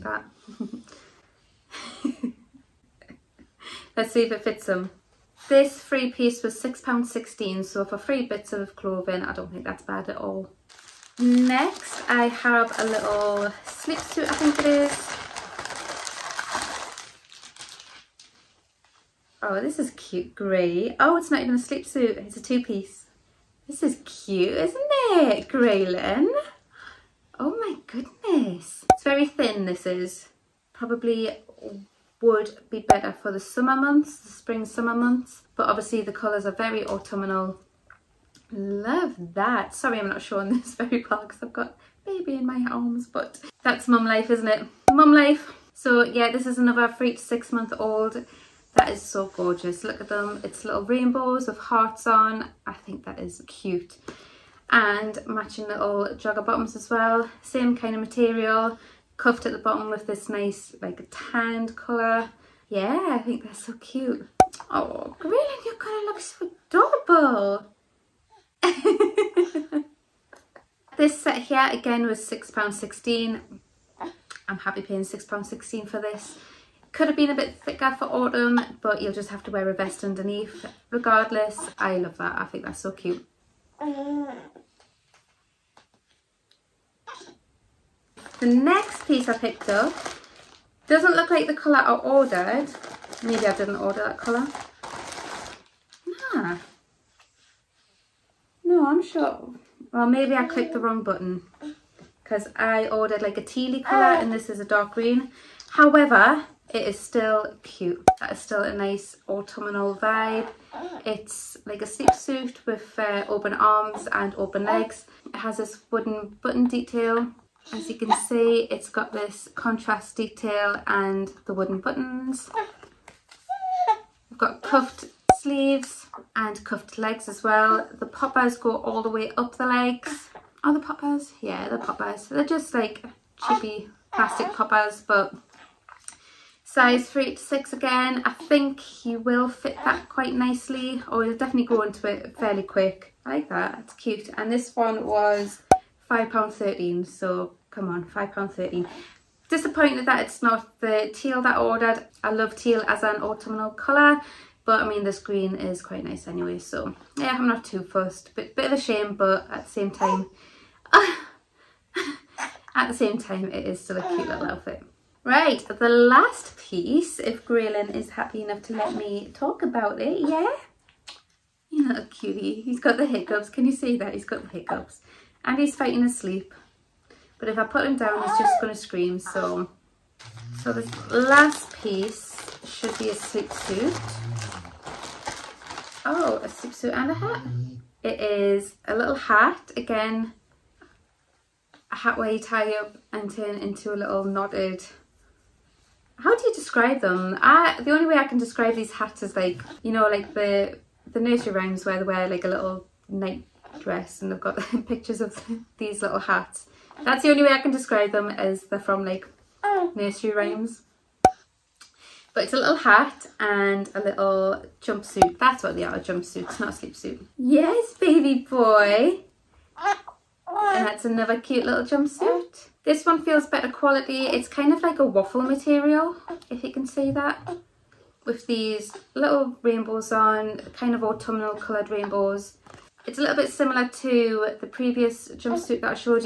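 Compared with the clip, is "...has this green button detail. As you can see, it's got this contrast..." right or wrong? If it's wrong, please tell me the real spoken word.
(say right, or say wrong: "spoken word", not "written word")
wrong: "wooden", not "green".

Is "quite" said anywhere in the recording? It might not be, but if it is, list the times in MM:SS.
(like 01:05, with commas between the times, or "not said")
02:20, 02:35.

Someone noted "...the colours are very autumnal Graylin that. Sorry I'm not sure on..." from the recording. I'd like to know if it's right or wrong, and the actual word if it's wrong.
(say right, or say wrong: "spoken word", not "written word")
wrong: "Love", not "Graylin".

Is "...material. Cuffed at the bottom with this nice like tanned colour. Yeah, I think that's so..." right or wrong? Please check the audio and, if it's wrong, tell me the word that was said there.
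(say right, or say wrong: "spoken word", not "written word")
right.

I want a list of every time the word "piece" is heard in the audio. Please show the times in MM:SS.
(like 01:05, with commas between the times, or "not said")
00:06, 00:22, 01:29, 02:46, 03:01.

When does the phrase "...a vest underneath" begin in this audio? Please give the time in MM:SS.
01:19.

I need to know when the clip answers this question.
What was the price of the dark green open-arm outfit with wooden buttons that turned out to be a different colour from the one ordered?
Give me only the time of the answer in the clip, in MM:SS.
02:24.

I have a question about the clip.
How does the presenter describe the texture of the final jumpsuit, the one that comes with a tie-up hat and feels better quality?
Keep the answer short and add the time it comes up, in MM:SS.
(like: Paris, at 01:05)
Waffle material, at 03:45.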